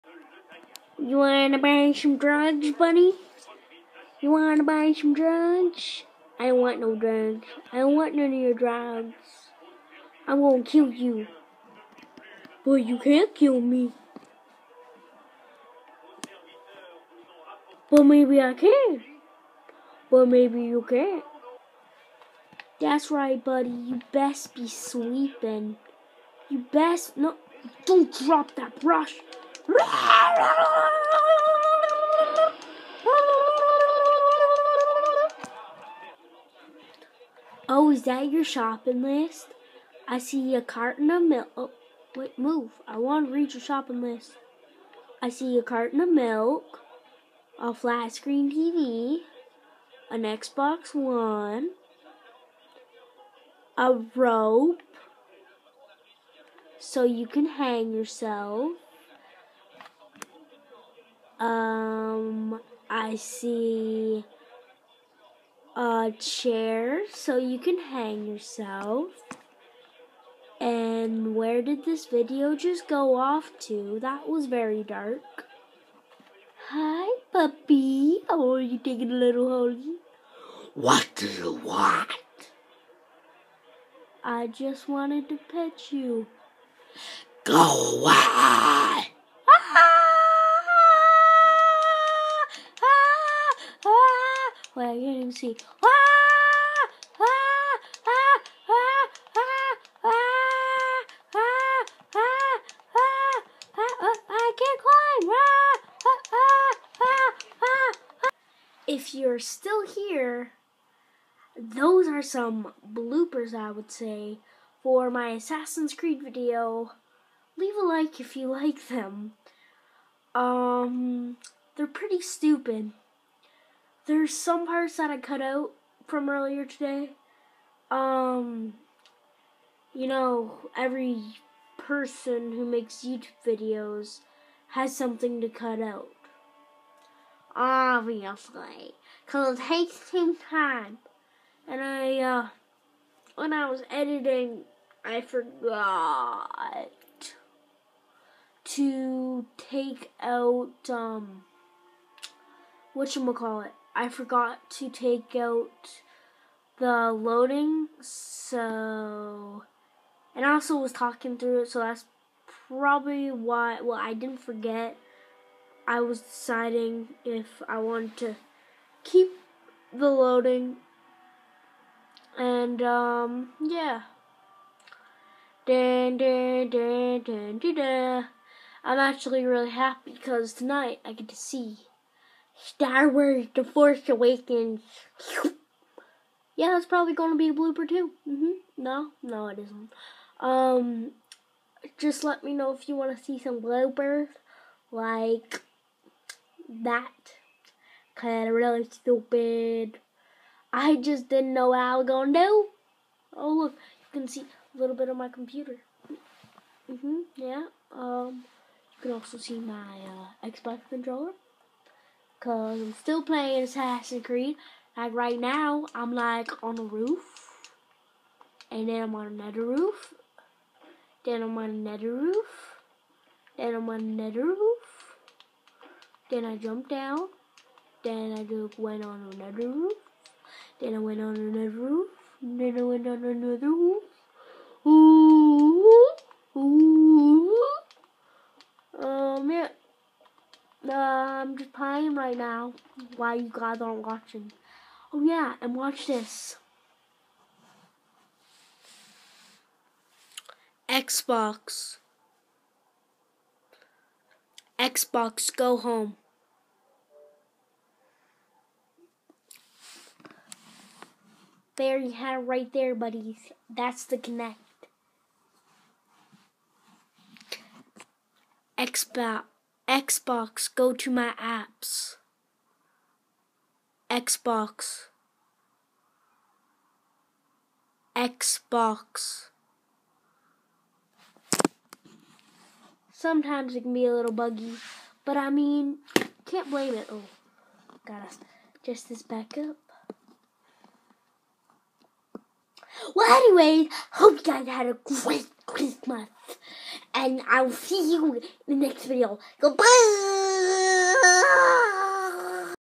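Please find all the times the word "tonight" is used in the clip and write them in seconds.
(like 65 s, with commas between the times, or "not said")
180 s.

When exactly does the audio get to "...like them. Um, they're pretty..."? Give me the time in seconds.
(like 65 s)
118 s.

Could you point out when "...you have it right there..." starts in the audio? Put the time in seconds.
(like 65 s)
261 s.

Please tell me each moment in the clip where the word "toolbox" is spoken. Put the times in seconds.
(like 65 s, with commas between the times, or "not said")
not said.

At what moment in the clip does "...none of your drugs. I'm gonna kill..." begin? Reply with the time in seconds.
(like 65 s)
8 s.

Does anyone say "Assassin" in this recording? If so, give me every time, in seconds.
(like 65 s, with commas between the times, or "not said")
115 s, 213 s.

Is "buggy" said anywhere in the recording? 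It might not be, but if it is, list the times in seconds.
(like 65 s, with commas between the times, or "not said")
284 s.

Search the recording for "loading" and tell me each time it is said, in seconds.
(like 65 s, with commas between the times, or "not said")
157 s, 170 s.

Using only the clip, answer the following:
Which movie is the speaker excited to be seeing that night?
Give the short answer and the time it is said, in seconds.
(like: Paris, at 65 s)
Star Wars The Force Awakens, at 182 s.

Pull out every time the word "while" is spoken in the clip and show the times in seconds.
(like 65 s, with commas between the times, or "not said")
243 s.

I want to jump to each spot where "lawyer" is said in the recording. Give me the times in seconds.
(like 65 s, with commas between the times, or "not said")
not said.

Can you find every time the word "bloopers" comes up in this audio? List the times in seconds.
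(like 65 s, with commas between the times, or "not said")
112 s, 187 s, 193 s.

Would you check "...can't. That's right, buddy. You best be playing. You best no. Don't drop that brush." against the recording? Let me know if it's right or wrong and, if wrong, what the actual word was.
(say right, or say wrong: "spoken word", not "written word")
wrong: "sweeping", not "playing".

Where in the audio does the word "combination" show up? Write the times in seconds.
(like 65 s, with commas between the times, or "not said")
not said.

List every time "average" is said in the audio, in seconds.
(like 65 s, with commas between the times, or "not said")
not said.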